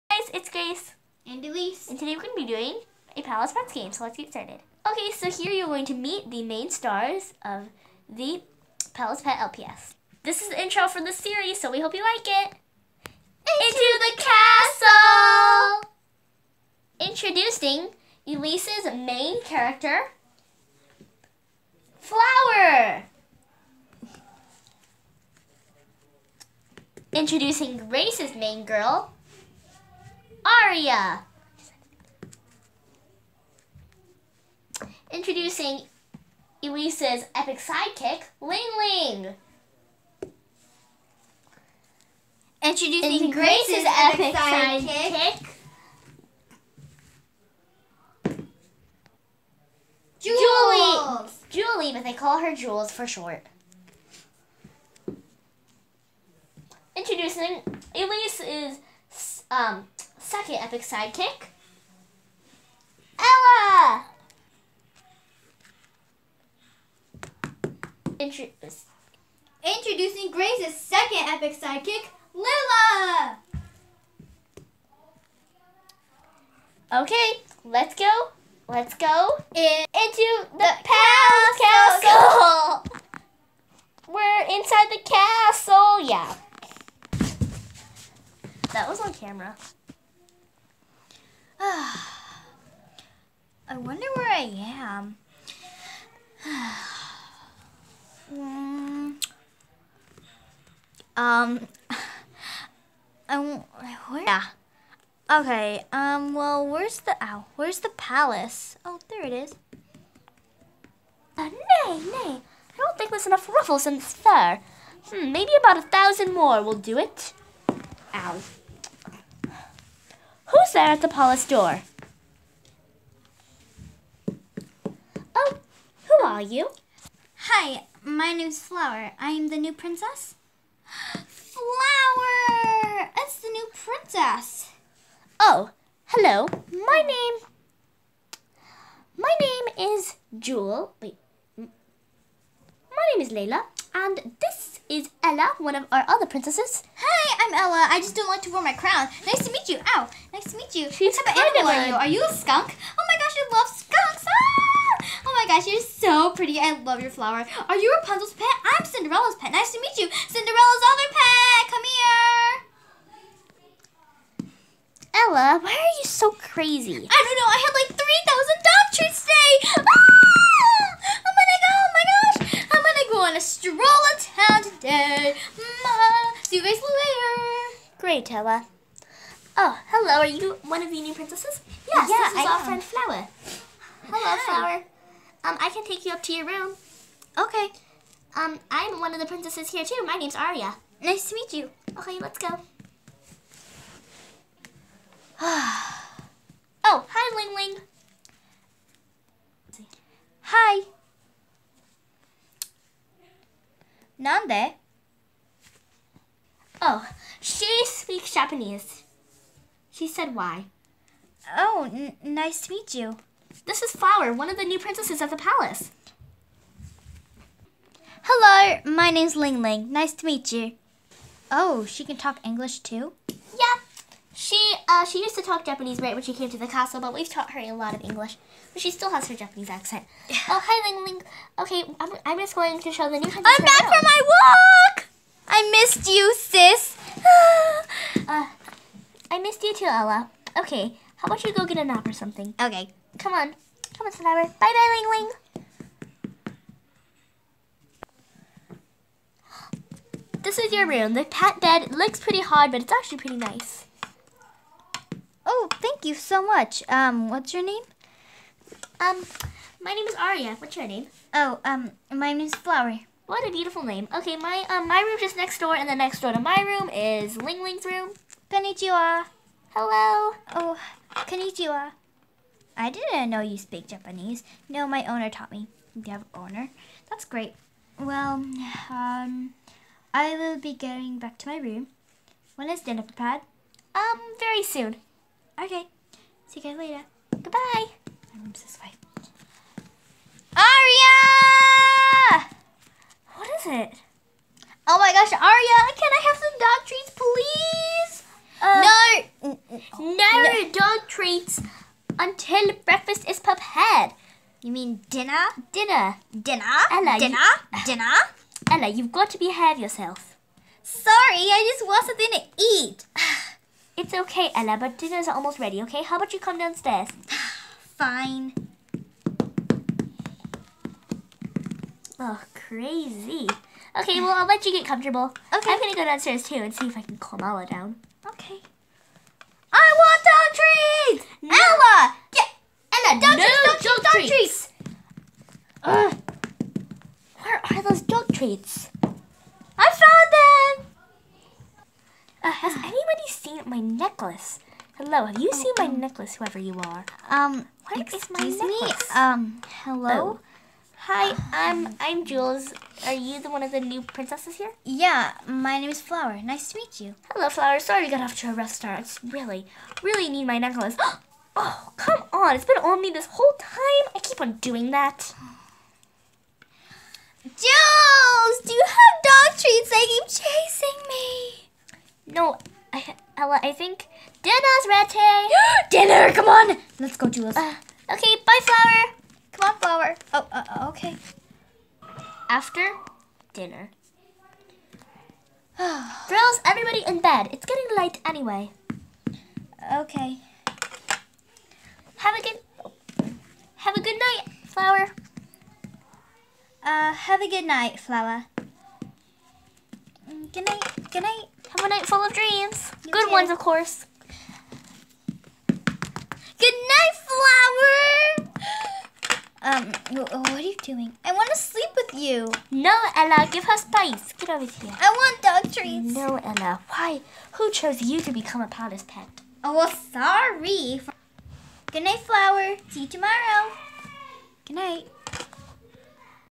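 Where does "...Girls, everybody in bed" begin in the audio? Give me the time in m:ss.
6:25.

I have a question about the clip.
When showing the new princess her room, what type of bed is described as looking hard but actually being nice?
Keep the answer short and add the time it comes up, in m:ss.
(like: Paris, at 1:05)
Cat bed, at 4:11.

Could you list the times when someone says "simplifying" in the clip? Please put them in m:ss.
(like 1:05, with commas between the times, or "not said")
not said.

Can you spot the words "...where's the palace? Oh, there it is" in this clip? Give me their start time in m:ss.
1:47.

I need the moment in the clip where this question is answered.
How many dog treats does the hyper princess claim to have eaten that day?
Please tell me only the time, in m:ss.
2:47.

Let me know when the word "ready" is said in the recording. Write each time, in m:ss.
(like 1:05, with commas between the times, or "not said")
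5:15, 6:14.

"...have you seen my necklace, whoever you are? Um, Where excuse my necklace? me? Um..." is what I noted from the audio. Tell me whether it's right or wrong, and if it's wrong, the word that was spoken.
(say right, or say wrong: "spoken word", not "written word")
right.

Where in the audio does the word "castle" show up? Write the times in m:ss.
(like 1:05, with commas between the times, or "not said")
0:15, 3:46.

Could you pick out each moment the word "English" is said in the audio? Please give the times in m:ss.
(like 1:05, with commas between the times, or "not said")
3:42, 3:48.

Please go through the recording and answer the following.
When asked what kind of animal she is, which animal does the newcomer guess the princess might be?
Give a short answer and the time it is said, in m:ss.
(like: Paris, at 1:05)
A skunk, at 2:32.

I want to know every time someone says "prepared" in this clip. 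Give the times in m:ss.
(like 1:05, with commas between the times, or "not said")
4:43, 5:03.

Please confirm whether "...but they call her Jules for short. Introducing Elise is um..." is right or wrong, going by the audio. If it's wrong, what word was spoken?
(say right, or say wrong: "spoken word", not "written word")
right.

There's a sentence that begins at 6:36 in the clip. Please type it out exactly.
Uh, have a good night, Flower.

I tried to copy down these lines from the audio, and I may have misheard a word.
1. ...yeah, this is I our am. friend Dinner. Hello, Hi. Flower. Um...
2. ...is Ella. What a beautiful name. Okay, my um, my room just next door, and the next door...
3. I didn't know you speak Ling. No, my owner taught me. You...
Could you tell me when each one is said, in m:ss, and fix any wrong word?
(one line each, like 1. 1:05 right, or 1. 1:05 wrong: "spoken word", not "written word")
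1. 3:02 wrong: "Flower", not "Dinner"
2. 4:22 wrong: "Flower", not "Ella"
3. 4:32 wrong: "Japanese", not "Ling".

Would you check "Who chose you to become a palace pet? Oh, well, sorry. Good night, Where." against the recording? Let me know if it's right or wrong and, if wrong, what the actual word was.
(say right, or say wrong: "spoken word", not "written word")
wrong: "Flower", not "Where".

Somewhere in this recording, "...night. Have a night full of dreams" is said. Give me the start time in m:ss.
6:41.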